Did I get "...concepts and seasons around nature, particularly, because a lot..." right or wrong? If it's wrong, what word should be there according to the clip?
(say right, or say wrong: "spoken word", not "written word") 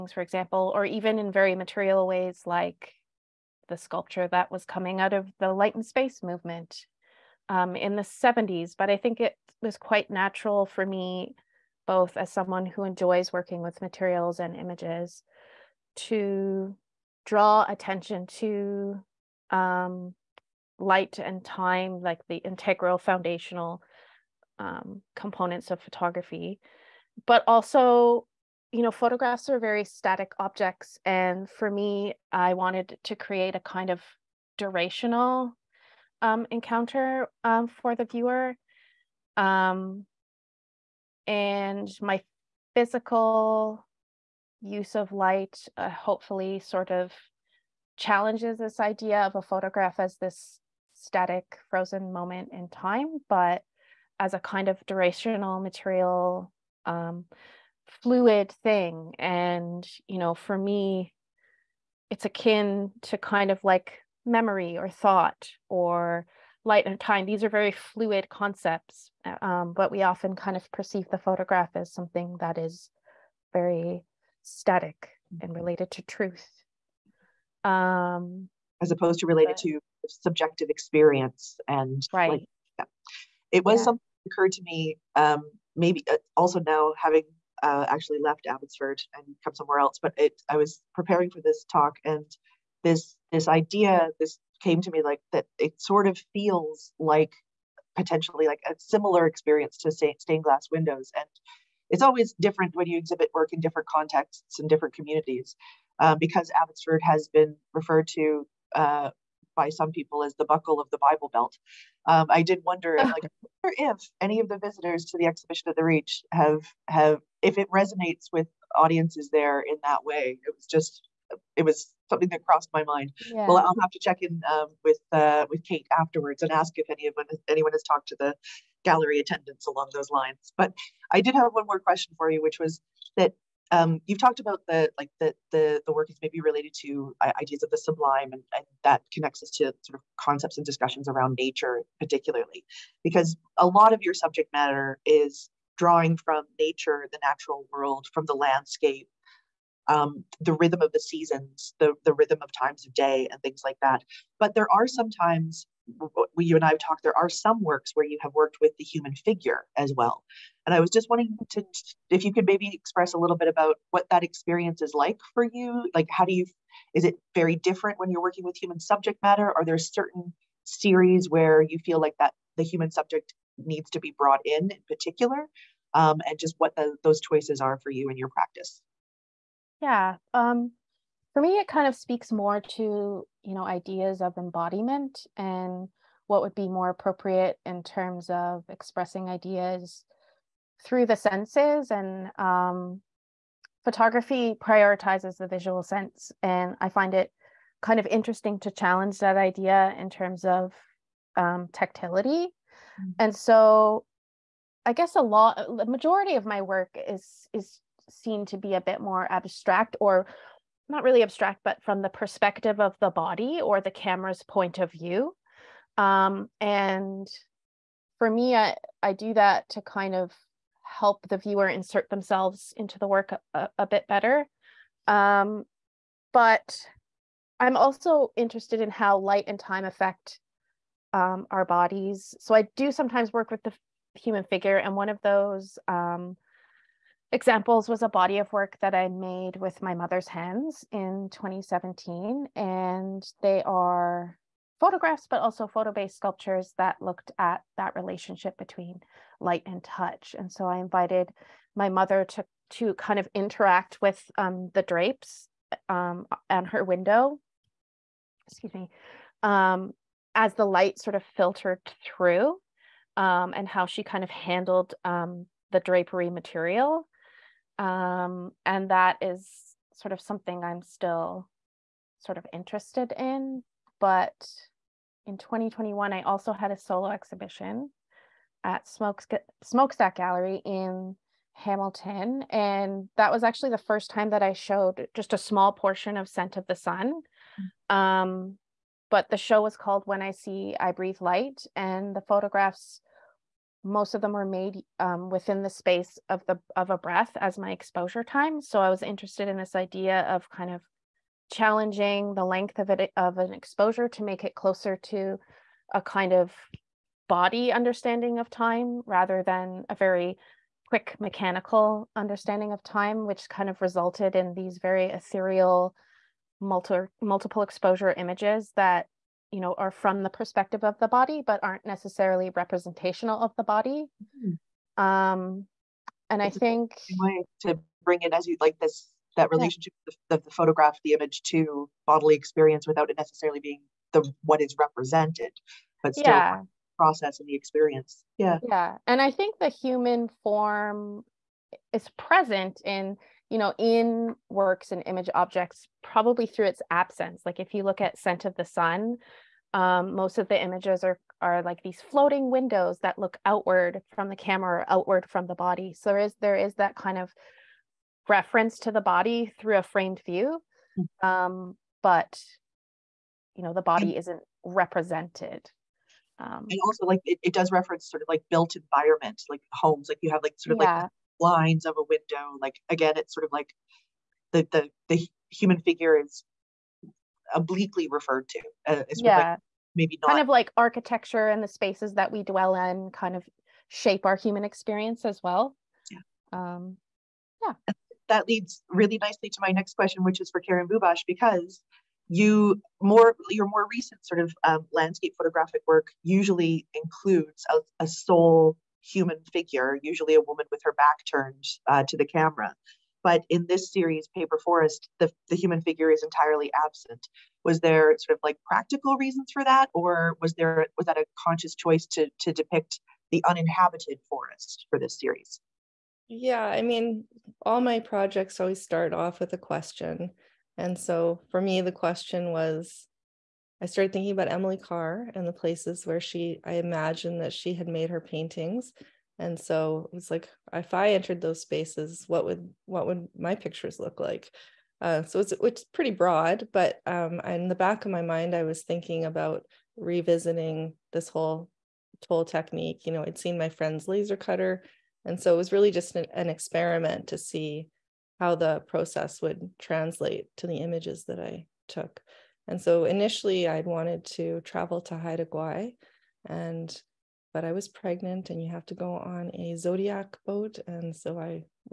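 wrong: "discussions", not "seasons".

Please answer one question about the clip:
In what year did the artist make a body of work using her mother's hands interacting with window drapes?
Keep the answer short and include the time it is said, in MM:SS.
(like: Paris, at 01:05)
2017, at 04:01.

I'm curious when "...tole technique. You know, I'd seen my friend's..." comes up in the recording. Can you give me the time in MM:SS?
07:22.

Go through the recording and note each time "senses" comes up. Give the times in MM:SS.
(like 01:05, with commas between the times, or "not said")
03:11, 03:15.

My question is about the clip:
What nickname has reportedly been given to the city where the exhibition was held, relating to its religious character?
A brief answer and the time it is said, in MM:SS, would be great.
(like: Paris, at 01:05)
buckle of the Bible Belt, at 01:50.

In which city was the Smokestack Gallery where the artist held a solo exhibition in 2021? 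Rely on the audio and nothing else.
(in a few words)
Hamilton.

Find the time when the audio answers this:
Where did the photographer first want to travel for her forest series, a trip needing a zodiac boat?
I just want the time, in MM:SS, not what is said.
07:35.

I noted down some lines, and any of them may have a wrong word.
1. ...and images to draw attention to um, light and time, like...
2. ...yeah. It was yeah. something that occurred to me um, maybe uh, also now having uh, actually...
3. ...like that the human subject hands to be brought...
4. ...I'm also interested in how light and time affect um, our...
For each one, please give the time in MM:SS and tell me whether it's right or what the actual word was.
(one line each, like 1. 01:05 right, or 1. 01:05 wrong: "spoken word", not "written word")
1. 00:14 right
2. 01:22 right
3. 02:51 wrong: "needs", not "hands"
4. 03:47 right.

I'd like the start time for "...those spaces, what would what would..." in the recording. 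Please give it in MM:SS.
07:11.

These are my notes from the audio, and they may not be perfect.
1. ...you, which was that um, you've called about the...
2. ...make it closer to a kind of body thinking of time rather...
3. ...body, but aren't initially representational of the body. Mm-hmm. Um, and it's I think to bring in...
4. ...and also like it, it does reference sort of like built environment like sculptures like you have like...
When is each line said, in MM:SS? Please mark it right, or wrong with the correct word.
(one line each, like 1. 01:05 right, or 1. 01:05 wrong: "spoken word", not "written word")
1. 02:12 wrong: "talked", not "called"
2. 05:04 wrong: "understanding", not "thinking"
3. 05:21 wrong: "necessarily", not "initially"
4. 06:06 wrong: "homes", not "sculptures".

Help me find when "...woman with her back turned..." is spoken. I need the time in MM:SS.
06:40.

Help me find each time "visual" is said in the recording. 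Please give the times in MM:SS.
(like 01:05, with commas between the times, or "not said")
03:15.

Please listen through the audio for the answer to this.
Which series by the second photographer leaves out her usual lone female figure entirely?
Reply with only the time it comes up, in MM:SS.
06:44.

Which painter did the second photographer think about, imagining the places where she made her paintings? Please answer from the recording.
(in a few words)
Emily Carr.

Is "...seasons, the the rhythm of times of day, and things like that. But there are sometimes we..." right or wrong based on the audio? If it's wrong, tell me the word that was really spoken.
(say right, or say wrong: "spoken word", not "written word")
right.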